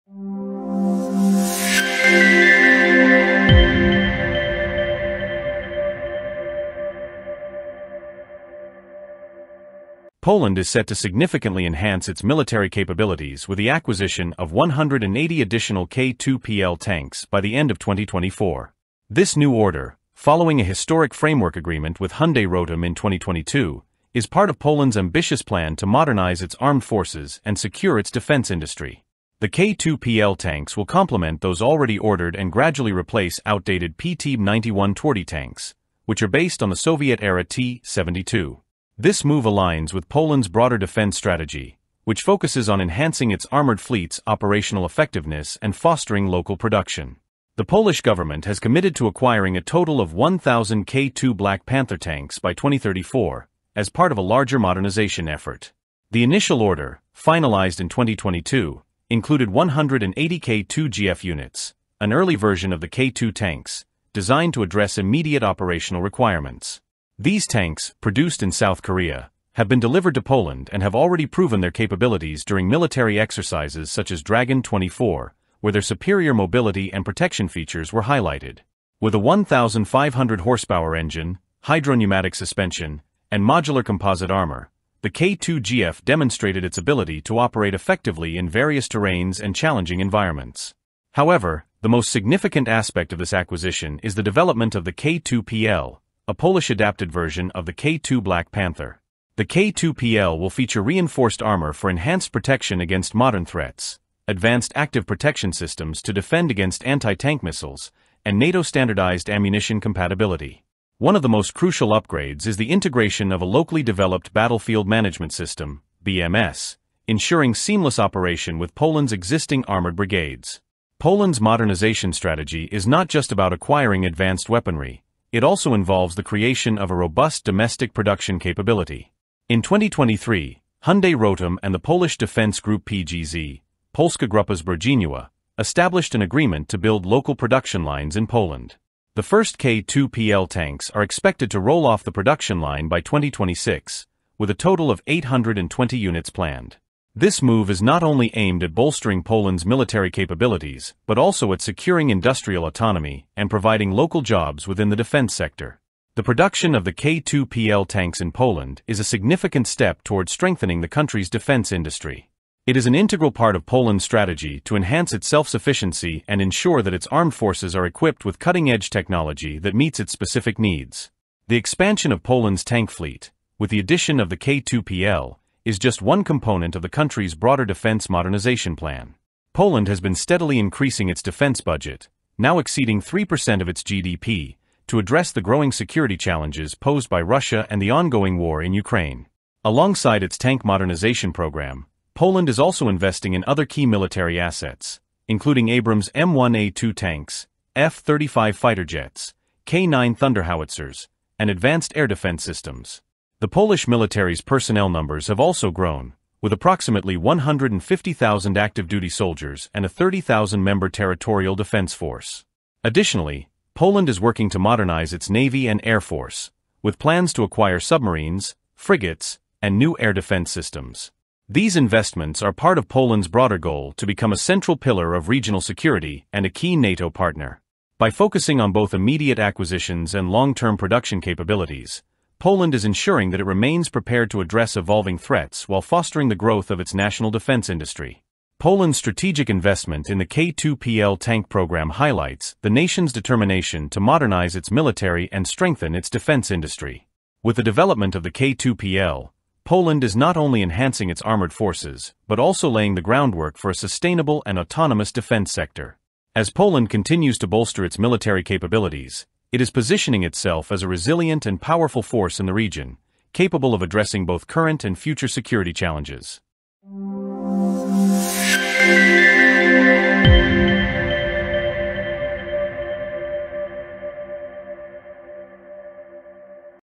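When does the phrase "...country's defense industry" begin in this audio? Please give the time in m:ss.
2:40.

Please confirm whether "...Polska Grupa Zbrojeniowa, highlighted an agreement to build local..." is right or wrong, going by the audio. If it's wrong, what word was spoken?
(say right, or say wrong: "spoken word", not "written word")
wrong: "established", not "highlighted".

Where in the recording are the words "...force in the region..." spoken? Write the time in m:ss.
4:22.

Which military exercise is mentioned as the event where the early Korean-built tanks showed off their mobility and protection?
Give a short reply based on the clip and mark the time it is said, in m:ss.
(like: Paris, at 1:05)
Dragon 24, at 1:14.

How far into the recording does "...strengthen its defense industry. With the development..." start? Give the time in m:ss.
4:05.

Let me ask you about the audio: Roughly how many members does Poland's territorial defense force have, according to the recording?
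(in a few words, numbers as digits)
30,000.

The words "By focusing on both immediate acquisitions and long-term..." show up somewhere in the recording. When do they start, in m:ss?
3:47.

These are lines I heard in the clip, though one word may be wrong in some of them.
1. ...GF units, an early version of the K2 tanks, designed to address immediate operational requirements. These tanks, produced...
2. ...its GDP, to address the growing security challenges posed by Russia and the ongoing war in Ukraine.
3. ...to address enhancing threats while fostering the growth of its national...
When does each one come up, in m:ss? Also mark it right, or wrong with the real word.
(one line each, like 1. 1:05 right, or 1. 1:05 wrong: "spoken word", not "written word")
1. 1:00 right
2. 3:03 right
3. 3:54 wrong: "evolving", not "enhancing".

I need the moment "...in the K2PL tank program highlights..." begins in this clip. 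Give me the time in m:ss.
4:00.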